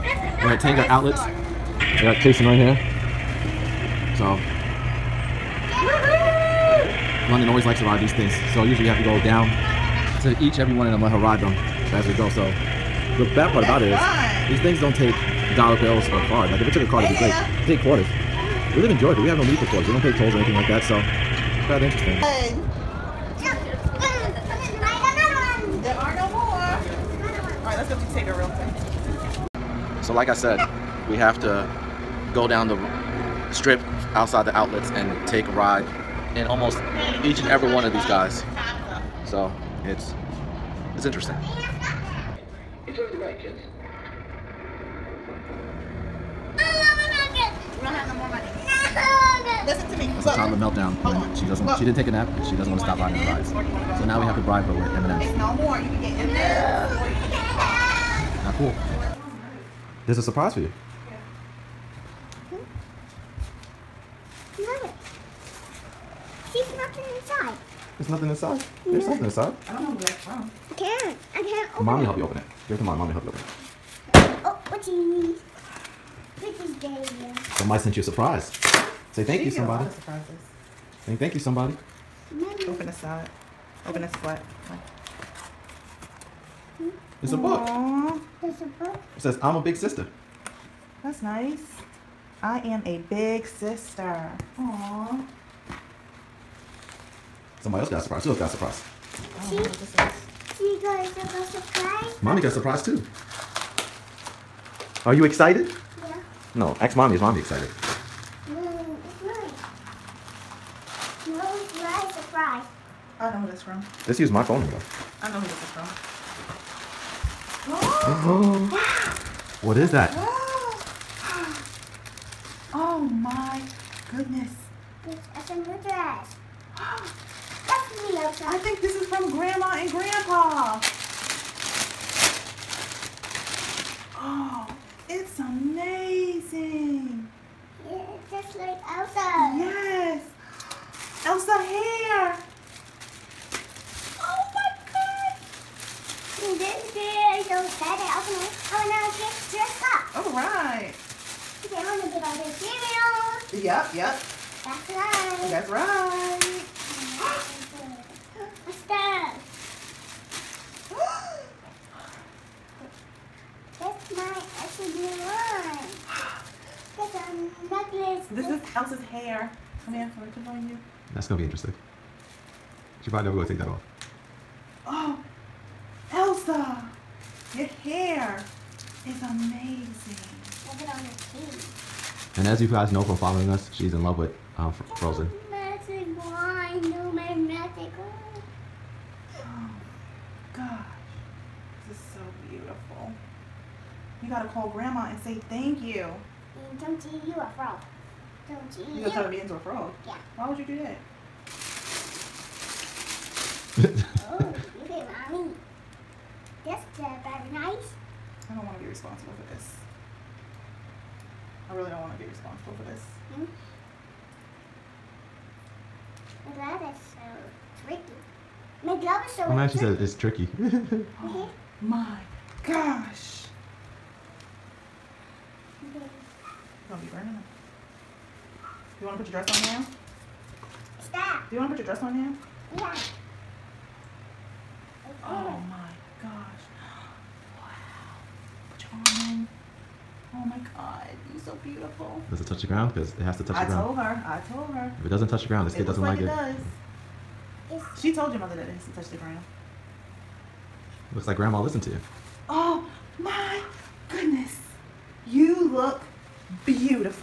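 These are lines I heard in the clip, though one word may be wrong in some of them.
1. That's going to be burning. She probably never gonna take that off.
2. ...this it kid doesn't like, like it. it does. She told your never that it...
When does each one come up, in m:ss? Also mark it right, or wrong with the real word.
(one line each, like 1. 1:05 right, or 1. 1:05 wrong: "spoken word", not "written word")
1. 2:51 wrong: "interesting", not "burning"
2. 4:05 wrong: "mother", not "never".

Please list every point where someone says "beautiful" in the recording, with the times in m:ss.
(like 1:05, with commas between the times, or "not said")
4:01, 4:16.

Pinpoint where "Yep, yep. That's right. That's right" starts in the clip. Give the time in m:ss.
2:33.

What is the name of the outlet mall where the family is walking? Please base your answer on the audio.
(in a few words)
Tanger Outlets.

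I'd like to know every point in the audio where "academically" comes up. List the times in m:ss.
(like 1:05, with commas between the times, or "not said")
not said.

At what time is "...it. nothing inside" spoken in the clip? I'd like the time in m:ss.
1:06.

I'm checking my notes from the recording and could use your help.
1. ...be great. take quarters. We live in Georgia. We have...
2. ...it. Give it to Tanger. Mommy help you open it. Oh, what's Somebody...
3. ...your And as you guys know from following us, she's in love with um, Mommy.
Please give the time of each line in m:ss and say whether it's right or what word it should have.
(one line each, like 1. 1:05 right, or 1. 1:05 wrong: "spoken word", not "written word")
1. 0:17 right
2. 1:12 wrong: "Mommy", not "Tanger"
3. 3:02 wrong: "Frozen", not "Mommy".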